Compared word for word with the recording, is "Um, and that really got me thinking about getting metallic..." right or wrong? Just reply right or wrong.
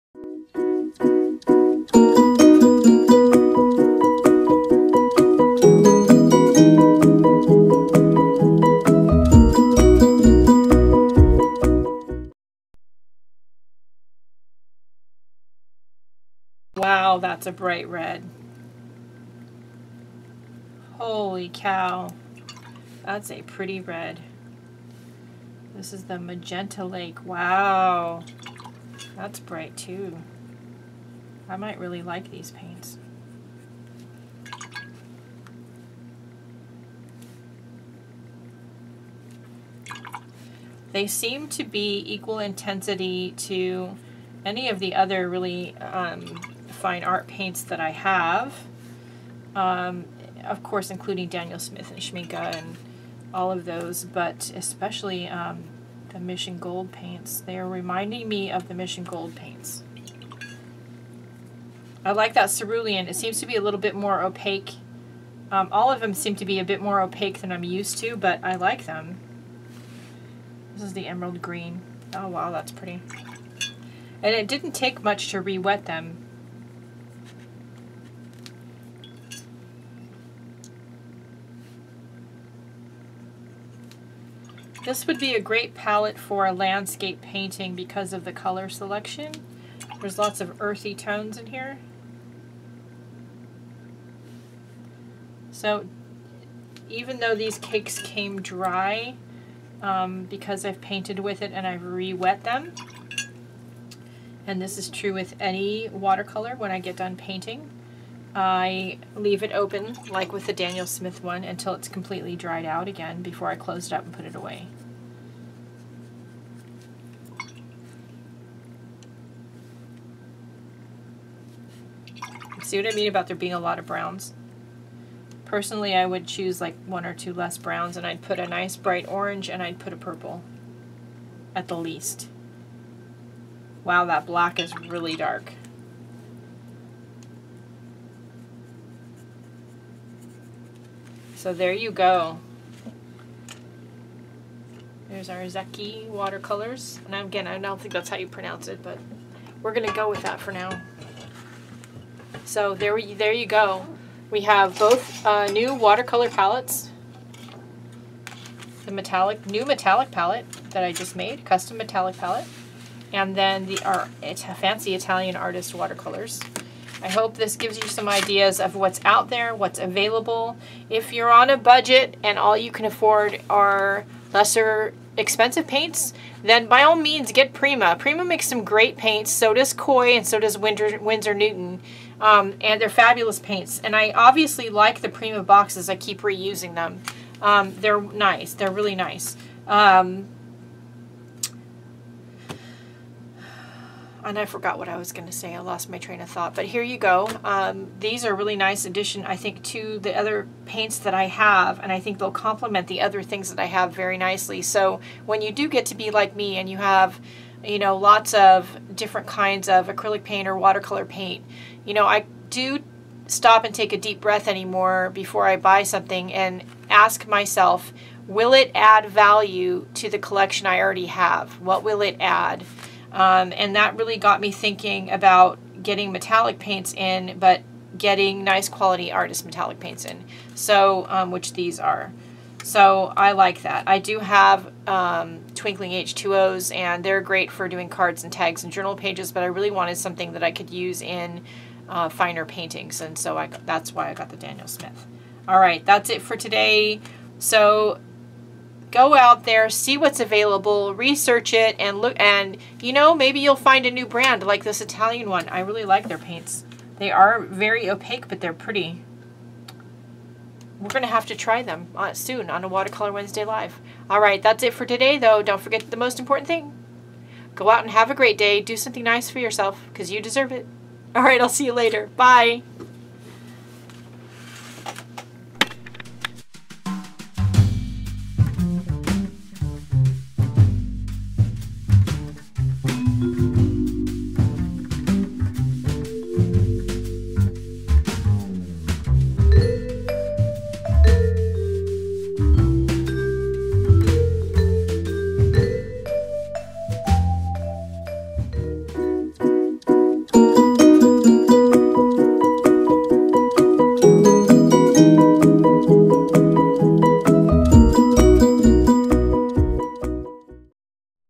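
right.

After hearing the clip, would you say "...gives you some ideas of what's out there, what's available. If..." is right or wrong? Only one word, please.
right.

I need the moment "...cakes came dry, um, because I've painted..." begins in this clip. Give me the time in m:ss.
1:37.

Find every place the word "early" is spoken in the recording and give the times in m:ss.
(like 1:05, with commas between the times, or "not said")
not said.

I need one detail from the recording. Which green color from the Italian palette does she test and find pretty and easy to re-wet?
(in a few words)
Emerald green.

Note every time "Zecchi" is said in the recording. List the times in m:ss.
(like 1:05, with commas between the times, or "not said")
2:25.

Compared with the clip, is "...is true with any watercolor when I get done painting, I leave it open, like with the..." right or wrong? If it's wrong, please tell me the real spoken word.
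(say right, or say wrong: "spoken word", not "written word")
right.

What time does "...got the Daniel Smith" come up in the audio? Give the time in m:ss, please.
4:04.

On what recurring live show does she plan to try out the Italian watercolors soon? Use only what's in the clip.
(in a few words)
Watercolor Wednesday Live.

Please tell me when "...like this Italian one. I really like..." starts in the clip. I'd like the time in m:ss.
4:14.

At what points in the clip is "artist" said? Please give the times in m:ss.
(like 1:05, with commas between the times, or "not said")
2:45, 3:49.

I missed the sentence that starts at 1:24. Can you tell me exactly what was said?
This would be a great palette for a landscape painting because of the color selection.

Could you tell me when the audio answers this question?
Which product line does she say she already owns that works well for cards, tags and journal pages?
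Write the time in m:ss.
3:55.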